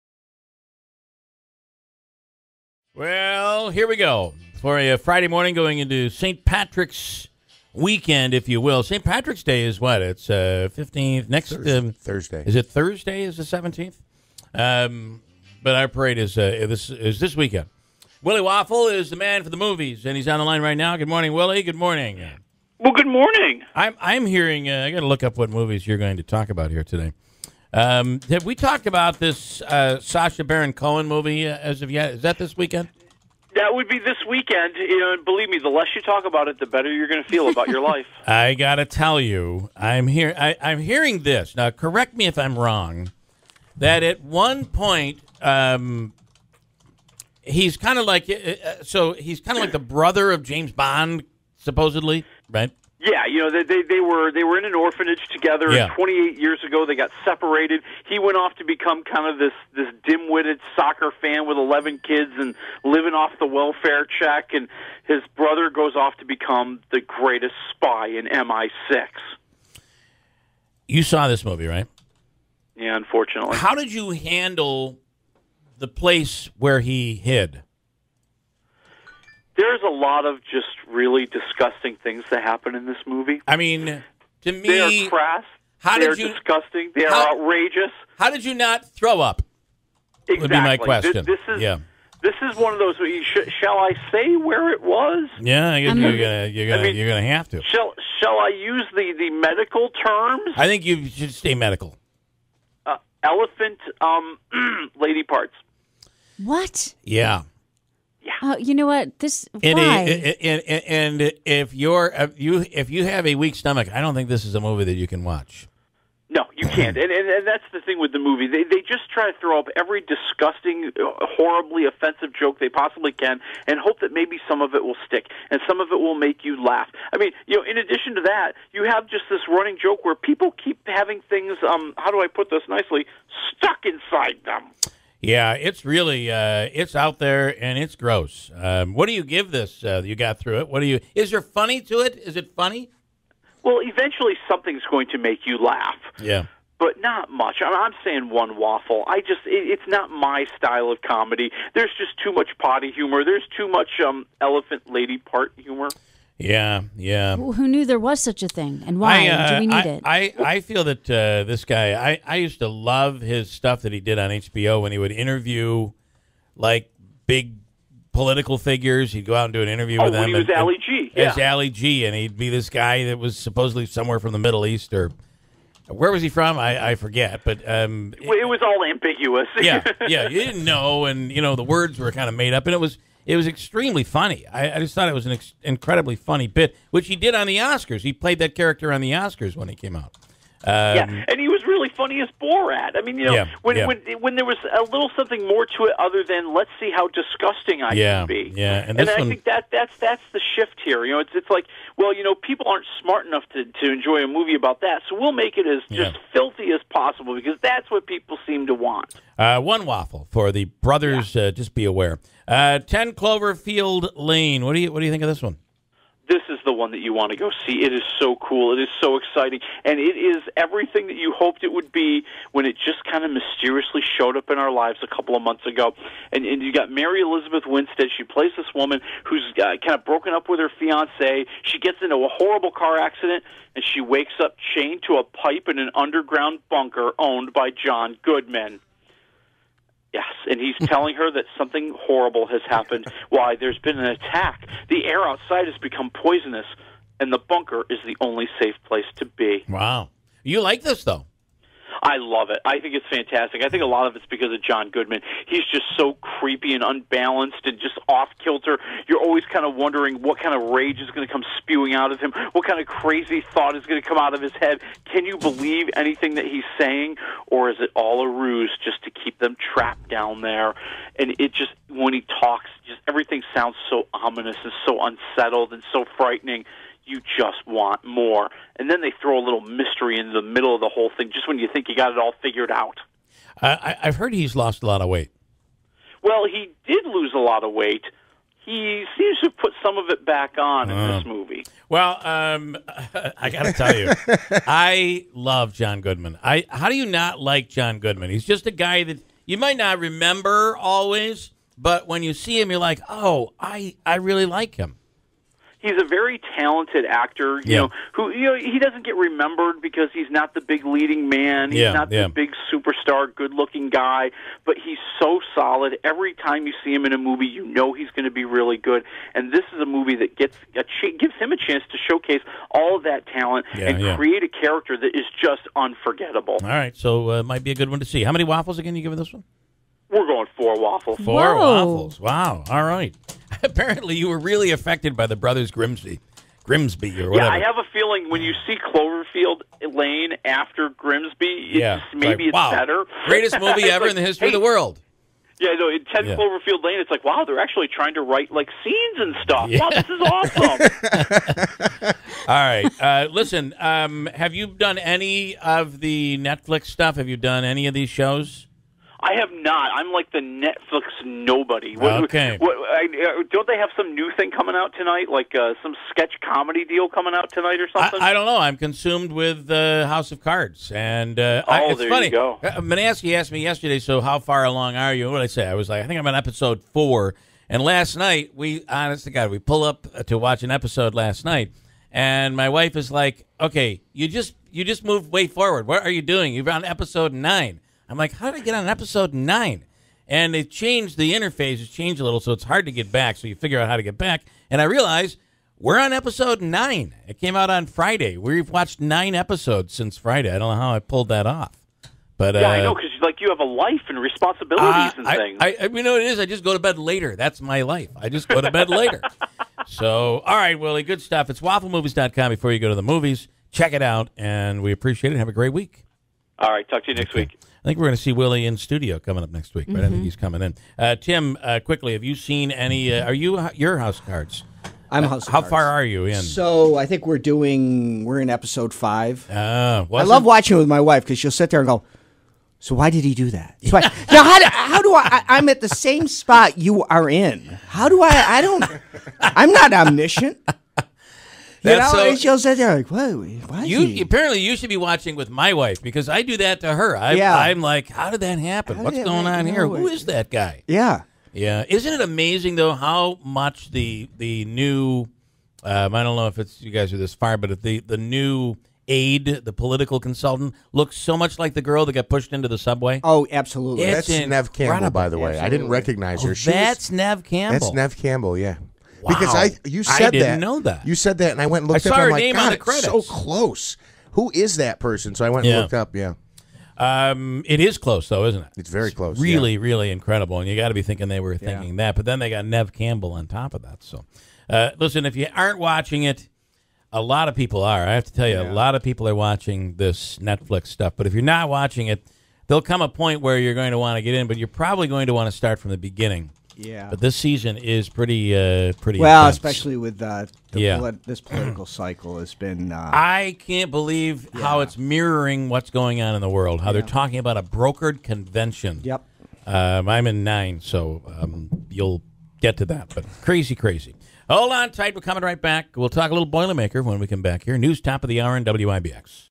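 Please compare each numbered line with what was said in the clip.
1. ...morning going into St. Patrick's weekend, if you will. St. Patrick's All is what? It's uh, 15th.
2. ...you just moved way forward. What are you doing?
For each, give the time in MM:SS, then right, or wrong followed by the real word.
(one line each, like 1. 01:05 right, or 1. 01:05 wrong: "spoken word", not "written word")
1. 00:05 wrong: "Day", not "All"
2. 06:24 right.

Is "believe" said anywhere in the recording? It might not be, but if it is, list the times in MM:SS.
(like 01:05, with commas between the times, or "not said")
00:35, 04:25, 08:23.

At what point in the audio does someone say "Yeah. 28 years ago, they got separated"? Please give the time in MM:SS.
00:55.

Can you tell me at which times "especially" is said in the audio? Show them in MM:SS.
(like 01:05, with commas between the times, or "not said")
08:19.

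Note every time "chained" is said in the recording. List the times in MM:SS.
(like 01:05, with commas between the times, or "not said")
03:54.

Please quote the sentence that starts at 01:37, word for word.
Shall Shall I use the the medical terms?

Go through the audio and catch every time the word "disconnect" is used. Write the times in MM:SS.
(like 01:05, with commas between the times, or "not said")
not said.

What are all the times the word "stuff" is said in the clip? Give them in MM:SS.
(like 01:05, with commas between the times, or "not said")
02:43, 05:49, 05:56, 06:51, 08:10.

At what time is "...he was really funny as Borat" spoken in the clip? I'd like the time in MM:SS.
03:11.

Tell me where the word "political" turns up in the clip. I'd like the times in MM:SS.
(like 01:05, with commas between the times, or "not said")
02:48, 07:39, 08:21.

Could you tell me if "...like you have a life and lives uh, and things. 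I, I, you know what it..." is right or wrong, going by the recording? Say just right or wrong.
wrong.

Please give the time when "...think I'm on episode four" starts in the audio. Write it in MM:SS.
06:16.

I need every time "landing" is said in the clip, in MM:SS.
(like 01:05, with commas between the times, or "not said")
not said.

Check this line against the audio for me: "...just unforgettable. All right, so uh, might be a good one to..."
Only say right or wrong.
right.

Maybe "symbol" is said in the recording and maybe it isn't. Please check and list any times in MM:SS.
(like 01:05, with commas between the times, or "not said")
not said.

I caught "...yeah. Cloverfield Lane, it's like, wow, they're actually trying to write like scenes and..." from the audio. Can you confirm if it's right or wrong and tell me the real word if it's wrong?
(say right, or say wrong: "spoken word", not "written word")
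right.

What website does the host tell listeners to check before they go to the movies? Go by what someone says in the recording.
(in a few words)
wafflemovies.com.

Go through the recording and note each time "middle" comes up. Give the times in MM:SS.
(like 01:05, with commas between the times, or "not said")
02:54, 04:40.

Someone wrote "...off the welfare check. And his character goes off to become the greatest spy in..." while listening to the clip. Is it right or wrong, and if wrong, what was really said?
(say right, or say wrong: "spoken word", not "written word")
wrong: "brother", not "character".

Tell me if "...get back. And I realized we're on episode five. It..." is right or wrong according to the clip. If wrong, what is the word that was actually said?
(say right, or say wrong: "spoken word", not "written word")
wrong: "nine", not "five".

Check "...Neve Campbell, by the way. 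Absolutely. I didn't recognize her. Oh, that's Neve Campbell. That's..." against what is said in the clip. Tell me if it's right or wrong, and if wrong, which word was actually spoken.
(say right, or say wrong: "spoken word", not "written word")
right.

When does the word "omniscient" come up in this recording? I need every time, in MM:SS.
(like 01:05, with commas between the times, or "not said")
07:19.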